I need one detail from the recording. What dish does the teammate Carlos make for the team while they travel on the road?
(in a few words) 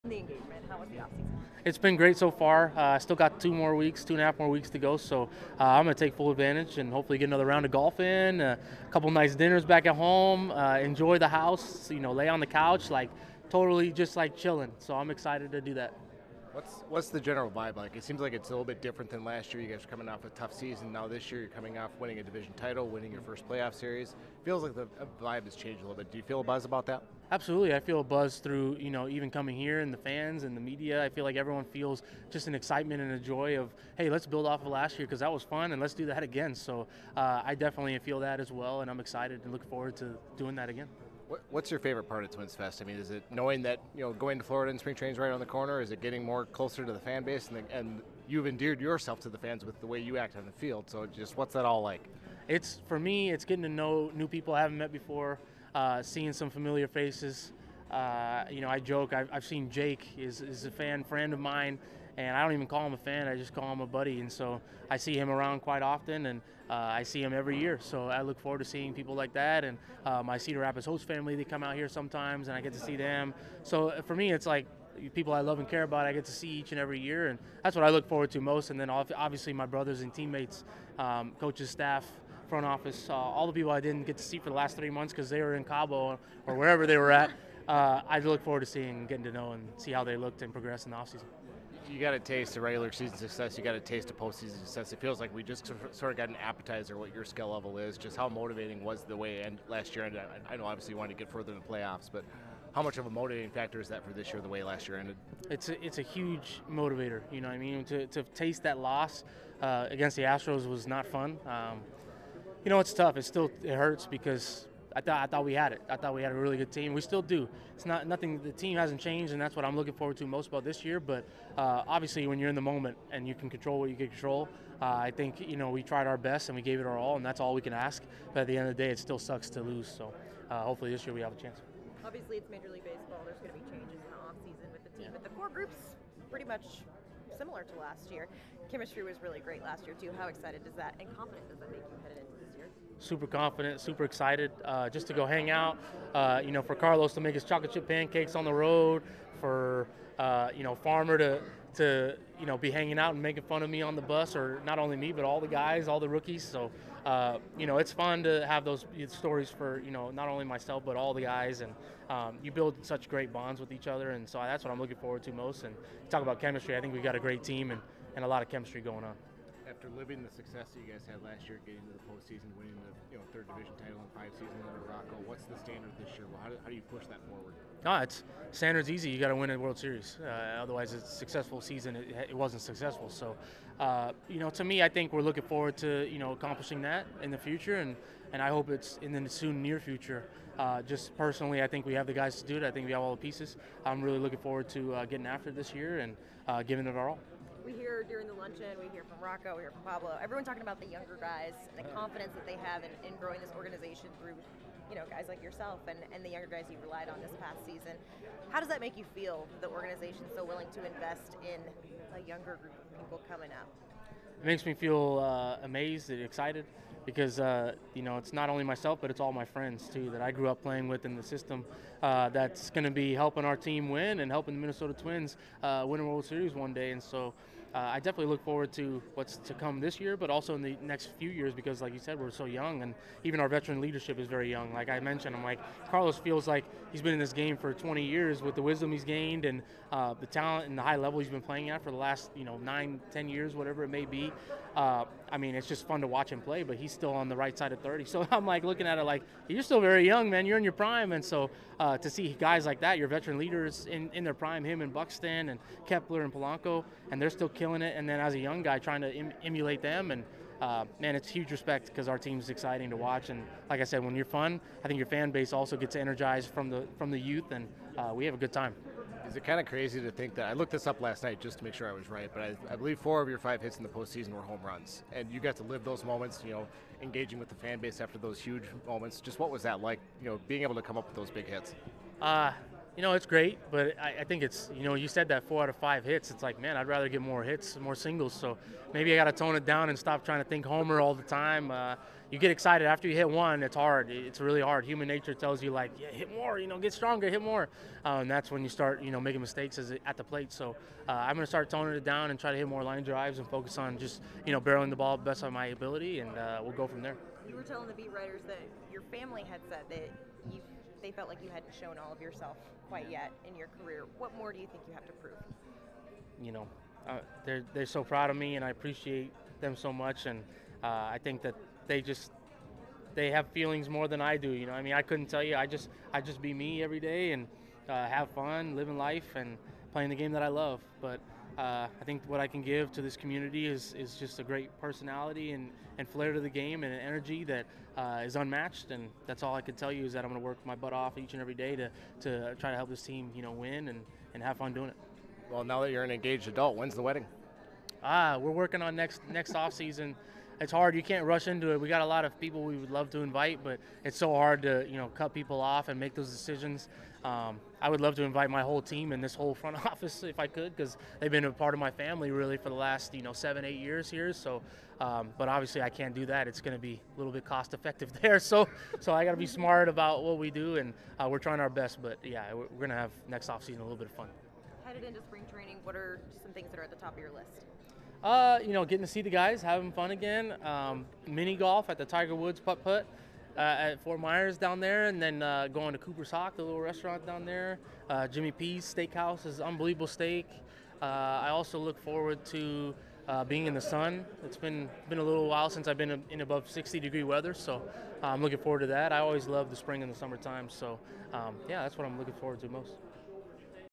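Chocolate chip pancakes.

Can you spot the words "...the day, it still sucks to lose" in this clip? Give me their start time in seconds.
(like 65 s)
128 s.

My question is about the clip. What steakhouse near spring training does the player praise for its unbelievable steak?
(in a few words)
Jimmy P's.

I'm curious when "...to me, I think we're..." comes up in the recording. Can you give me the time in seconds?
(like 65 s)
184 s.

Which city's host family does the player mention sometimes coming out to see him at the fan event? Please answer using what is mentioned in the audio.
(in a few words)
Cedar Rapids.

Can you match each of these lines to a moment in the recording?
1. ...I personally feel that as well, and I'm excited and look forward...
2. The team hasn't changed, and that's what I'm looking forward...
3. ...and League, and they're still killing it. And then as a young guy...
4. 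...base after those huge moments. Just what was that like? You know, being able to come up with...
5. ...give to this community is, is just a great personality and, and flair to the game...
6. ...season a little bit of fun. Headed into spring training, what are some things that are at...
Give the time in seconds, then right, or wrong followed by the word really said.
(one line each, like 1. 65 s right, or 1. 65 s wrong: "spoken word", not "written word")
1. 37 s wrong: "definitely", not "personally"
2. 118 s right
3. 256 s wrong: "Polanco", not "League"
4. 277 s right
5. 332 s right
6. 373 s right.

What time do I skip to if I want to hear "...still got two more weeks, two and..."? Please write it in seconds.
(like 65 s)
2 s.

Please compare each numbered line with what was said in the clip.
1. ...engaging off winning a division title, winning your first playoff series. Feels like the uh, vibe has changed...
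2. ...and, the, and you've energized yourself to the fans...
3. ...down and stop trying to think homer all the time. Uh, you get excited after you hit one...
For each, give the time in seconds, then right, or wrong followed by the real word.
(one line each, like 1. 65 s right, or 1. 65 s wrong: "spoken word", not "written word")
1. 21 s wrong: "coming", not "engaging"
2. 47 s wrong: "endeared", not "energized"
3. 289 s right.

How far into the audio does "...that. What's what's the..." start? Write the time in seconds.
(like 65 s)
15 s.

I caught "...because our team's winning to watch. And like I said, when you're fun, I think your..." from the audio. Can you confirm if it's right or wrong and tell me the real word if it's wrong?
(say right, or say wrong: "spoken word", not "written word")
wrong: "exciting", not "winning".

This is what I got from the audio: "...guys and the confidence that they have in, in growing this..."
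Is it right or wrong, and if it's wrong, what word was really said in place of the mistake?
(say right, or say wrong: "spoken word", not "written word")
right.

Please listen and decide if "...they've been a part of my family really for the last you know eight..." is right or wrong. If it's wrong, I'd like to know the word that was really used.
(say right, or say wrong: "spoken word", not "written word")
wrong: "seven", not "eight".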